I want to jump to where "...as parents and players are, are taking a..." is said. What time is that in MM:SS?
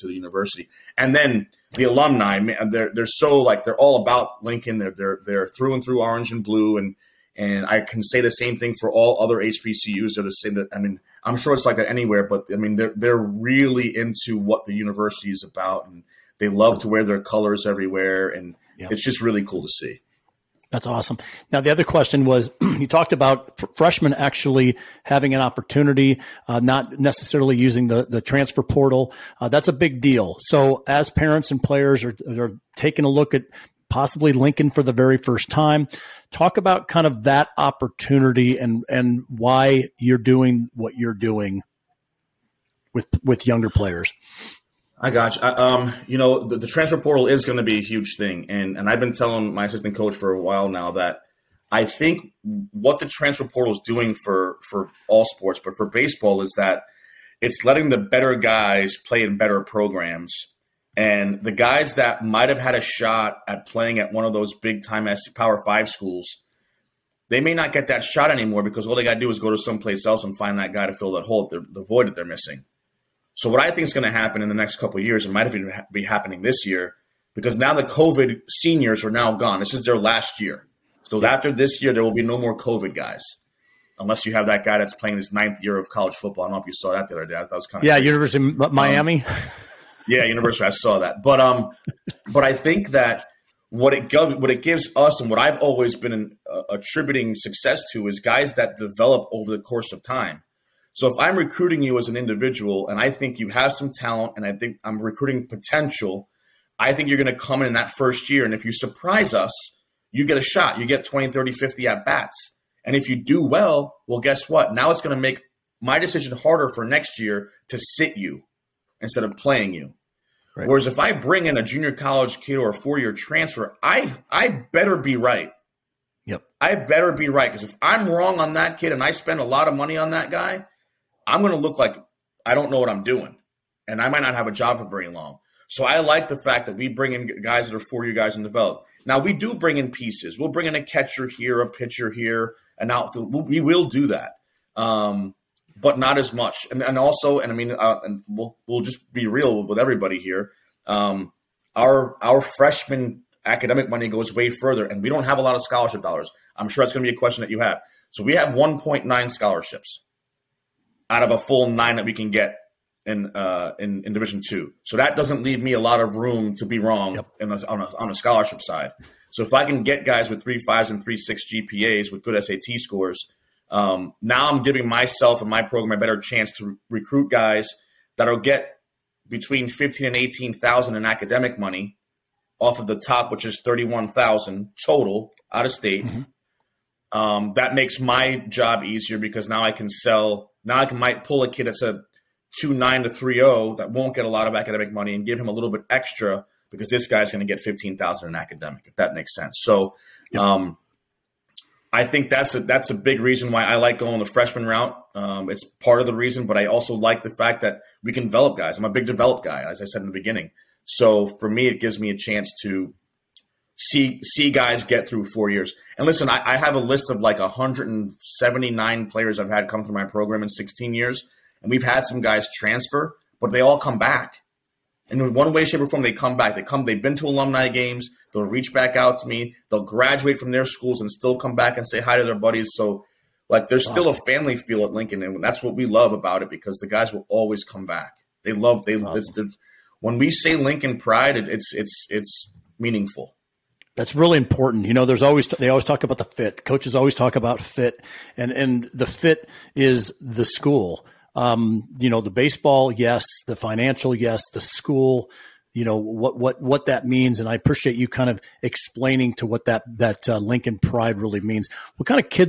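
00:30.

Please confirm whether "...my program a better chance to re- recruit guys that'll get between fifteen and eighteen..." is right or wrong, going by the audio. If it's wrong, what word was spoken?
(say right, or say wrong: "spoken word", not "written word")
right.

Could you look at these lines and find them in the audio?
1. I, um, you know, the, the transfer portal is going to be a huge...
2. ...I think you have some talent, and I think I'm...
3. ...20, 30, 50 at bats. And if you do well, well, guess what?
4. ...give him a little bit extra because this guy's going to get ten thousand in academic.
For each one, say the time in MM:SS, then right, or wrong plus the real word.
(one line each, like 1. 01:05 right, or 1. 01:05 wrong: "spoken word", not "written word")
1. 00:45 right
2. 01:42 right
3. 01:51 right
4. 03:15 wrong: "fifteen", not "ten".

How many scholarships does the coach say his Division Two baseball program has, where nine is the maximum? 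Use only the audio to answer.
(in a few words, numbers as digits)
1.9.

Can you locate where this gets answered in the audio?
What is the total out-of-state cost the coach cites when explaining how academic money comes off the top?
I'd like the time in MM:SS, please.
03:03.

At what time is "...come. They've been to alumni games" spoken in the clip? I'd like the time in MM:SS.
03:46.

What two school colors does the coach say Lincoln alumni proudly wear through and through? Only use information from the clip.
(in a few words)
orange and blue.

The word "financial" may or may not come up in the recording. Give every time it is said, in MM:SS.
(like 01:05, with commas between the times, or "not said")
04:13.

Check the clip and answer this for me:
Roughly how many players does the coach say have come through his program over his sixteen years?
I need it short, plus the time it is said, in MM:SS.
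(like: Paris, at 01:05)
179, at 03:37.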